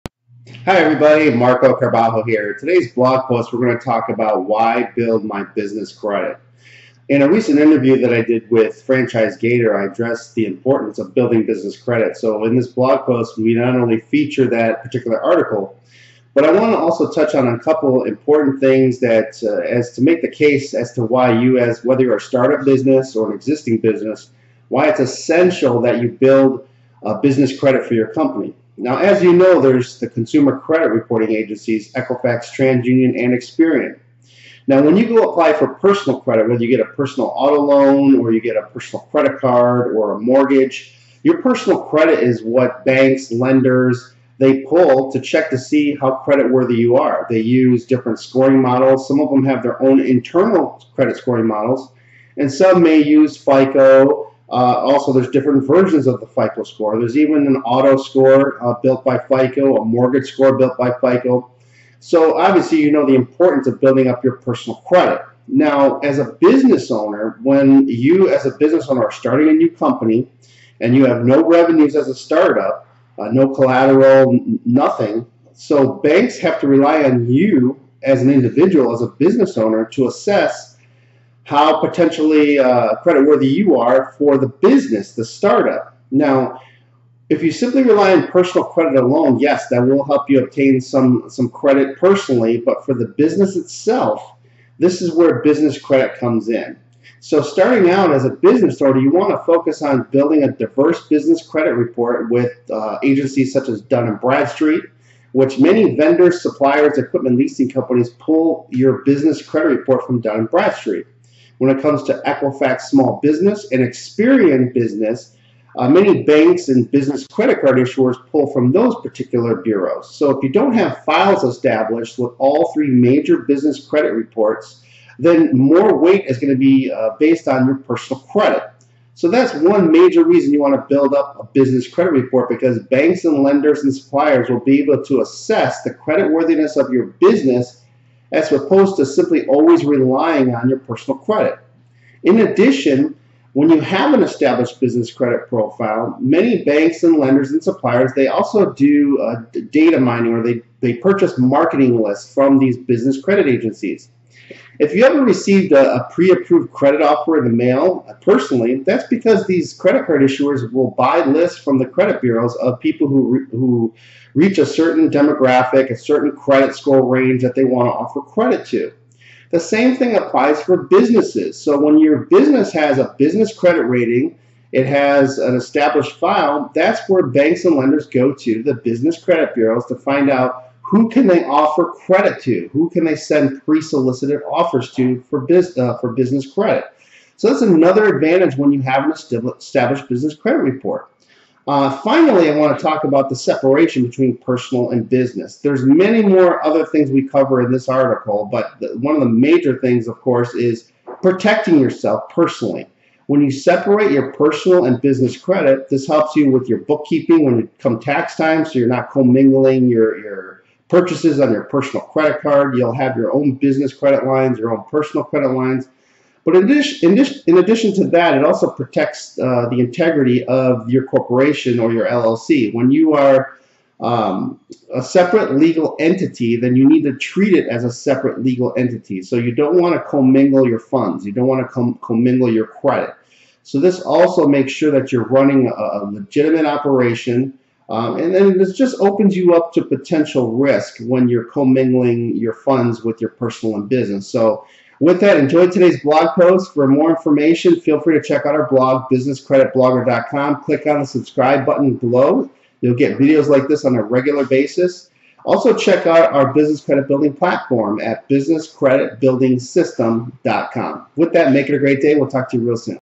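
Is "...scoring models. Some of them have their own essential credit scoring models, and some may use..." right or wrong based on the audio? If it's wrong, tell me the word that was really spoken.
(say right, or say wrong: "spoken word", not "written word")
wrong: "internal", not "essential".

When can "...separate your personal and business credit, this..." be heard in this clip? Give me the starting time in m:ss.
3:23.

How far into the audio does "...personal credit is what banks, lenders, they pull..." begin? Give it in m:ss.
0:41.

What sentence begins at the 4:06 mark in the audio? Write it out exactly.
For more information, feel free to check out our blog, businesscreditblogger.com.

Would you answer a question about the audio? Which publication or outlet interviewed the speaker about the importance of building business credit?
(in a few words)
Franchise Gator.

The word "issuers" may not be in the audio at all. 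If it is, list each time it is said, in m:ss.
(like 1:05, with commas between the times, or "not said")
1:57, 2:40.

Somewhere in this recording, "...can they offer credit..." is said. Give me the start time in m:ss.
3:01.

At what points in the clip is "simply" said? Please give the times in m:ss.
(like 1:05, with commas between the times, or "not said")
1:27, 2:19.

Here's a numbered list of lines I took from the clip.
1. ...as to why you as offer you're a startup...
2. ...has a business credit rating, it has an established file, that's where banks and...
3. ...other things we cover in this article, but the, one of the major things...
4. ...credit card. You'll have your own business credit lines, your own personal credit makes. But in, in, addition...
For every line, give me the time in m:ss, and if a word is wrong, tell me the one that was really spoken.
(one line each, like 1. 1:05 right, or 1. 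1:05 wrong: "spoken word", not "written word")
1. 0:20 wrong: "whether", not "offer"
2. 2:52 right
3. 3:16 right
4. 3:32 wrong: "lines", not "makes".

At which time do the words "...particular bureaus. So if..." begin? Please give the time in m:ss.
1:59.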